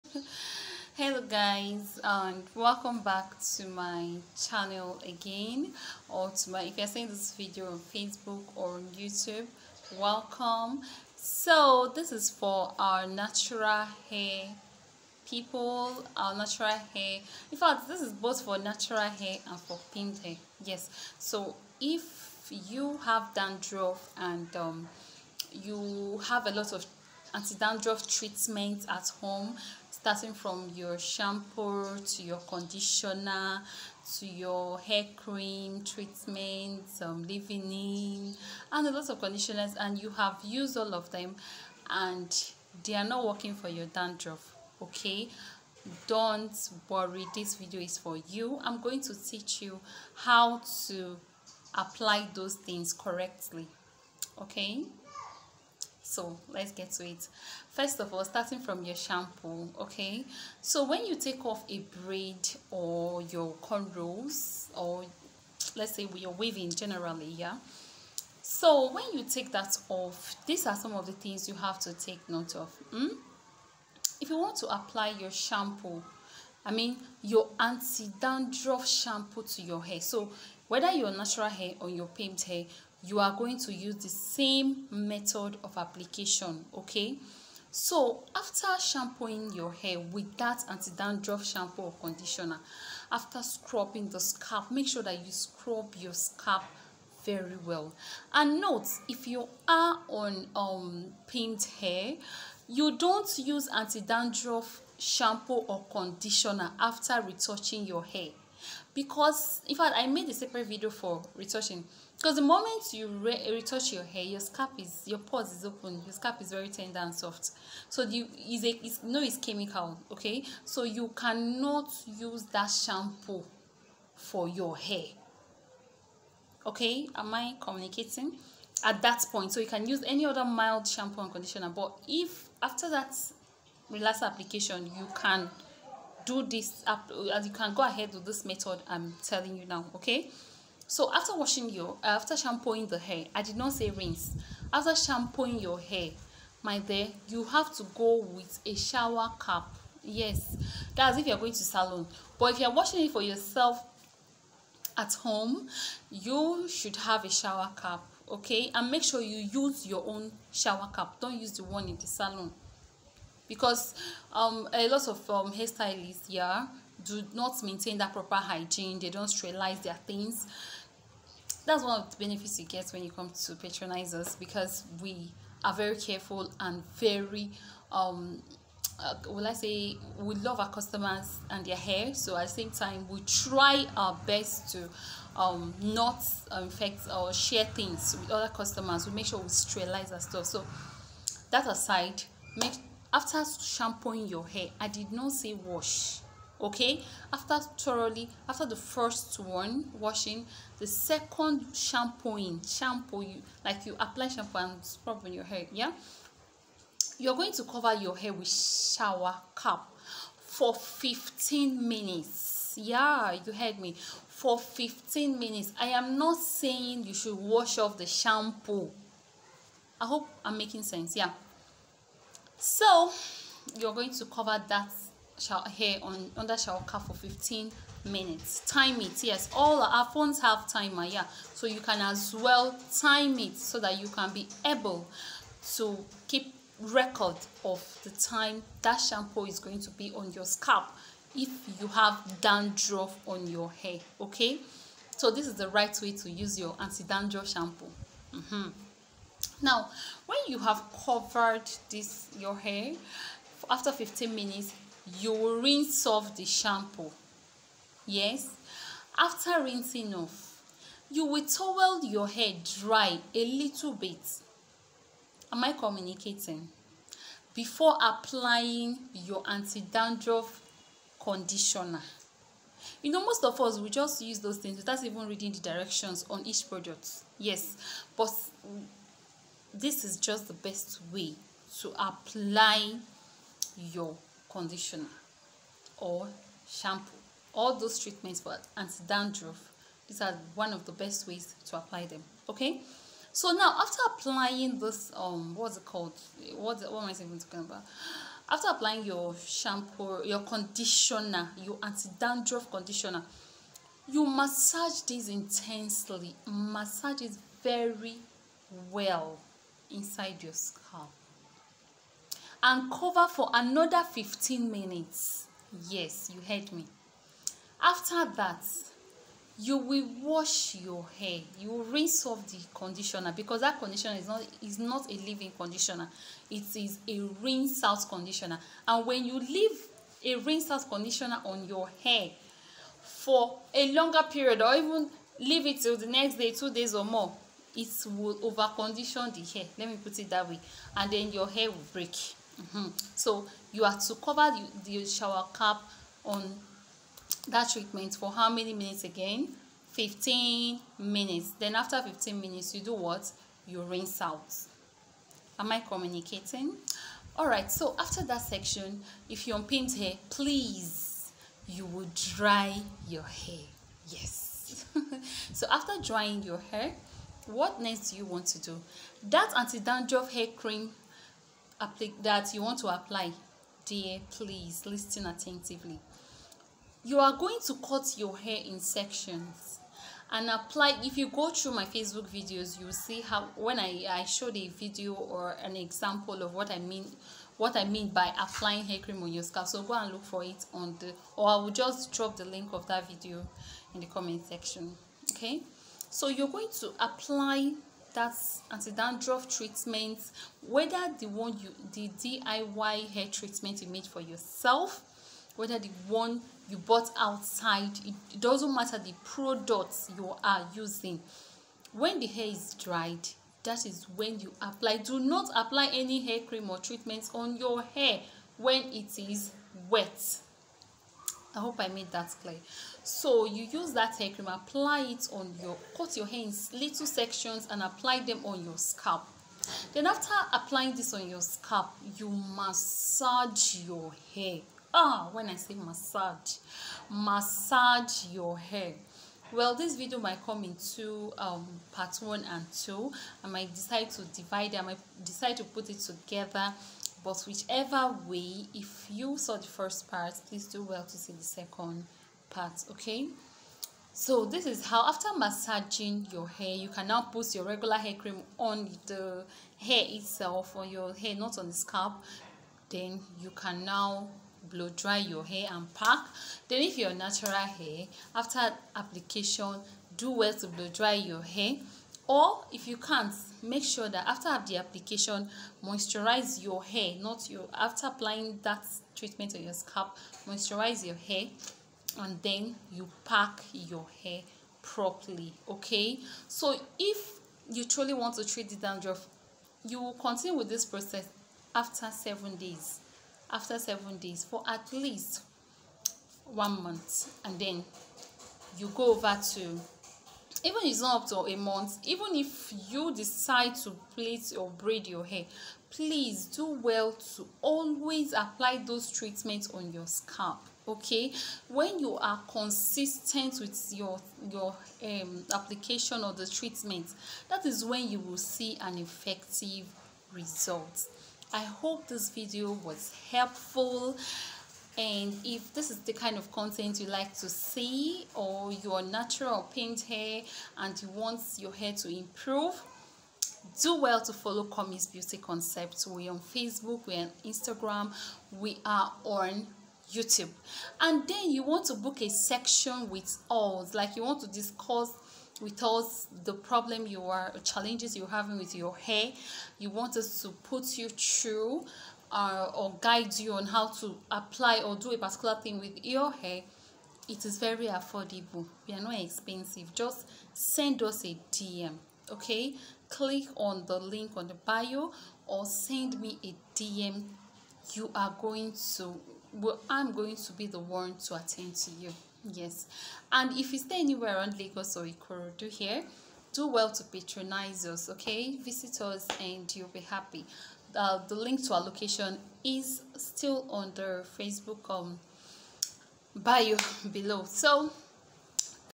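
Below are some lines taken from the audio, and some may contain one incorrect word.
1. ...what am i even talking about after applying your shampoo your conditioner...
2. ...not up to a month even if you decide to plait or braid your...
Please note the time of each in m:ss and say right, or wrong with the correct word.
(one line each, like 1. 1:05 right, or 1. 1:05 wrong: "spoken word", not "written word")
1. 4:56 right
2. 8:21 right.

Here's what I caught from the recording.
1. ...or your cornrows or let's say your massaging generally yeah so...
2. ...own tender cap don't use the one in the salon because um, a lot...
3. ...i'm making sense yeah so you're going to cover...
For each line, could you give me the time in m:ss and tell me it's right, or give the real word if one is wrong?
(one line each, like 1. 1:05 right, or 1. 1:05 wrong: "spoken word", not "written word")
1. 1:02 wrong: "weaving", not "massaging"
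2. 2:40 wrong: "shower", not "tender"
3. 3:40 right.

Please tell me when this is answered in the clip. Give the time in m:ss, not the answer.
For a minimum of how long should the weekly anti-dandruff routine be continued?
8:16.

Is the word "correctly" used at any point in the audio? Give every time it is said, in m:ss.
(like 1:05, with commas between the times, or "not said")
0:52.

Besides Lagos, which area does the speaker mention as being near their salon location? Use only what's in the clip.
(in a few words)
Ikorodu.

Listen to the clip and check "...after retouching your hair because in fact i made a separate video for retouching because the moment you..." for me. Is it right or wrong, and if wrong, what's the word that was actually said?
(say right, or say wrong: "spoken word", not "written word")
right.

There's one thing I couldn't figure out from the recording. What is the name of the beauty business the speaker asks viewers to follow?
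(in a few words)
Commy's Beauty Concepts.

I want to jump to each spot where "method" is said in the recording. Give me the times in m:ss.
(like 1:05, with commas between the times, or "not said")
1:24, 2:18.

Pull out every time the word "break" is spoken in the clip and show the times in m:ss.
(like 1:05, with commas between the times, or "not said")
5:41.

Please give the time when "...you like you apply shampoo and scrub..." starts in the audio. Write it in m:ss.
3:23.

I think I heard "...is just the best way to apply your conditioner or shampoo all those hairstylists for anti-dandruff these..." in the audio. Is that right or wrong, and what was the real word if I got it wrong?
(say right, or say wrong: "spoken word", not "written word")
wrong: "treatments", not "hairstylists".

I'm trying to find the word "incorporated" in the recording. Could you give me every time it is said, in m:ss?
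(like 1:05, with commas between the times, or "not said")
not said.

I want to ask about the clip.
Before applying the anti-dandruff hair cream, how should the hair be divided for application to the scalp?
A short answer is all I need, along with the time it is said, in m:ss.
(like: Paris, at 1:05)
In sections, at 6:17.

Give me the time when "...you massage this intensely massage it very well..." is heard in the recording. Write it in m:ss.
5:04.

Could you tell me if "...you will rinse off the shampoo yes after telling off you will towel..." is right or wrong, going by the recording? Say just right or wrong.
wrong.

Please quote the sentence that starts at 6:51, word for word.
When the hair is dried, that is when you apply.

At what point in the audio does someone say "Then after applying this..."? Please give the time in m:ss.
7:09.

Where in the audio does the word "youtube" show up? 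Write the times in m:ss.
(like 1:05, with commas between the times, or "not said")
0:08, 9:00.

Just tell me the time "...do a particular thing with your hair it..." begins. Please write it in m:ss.
9:14.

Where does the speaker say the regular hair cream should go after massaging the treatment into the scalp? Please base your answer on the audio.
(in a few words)
On the hair.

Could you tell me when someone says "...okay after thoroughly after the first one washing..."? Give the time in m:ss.
3:16.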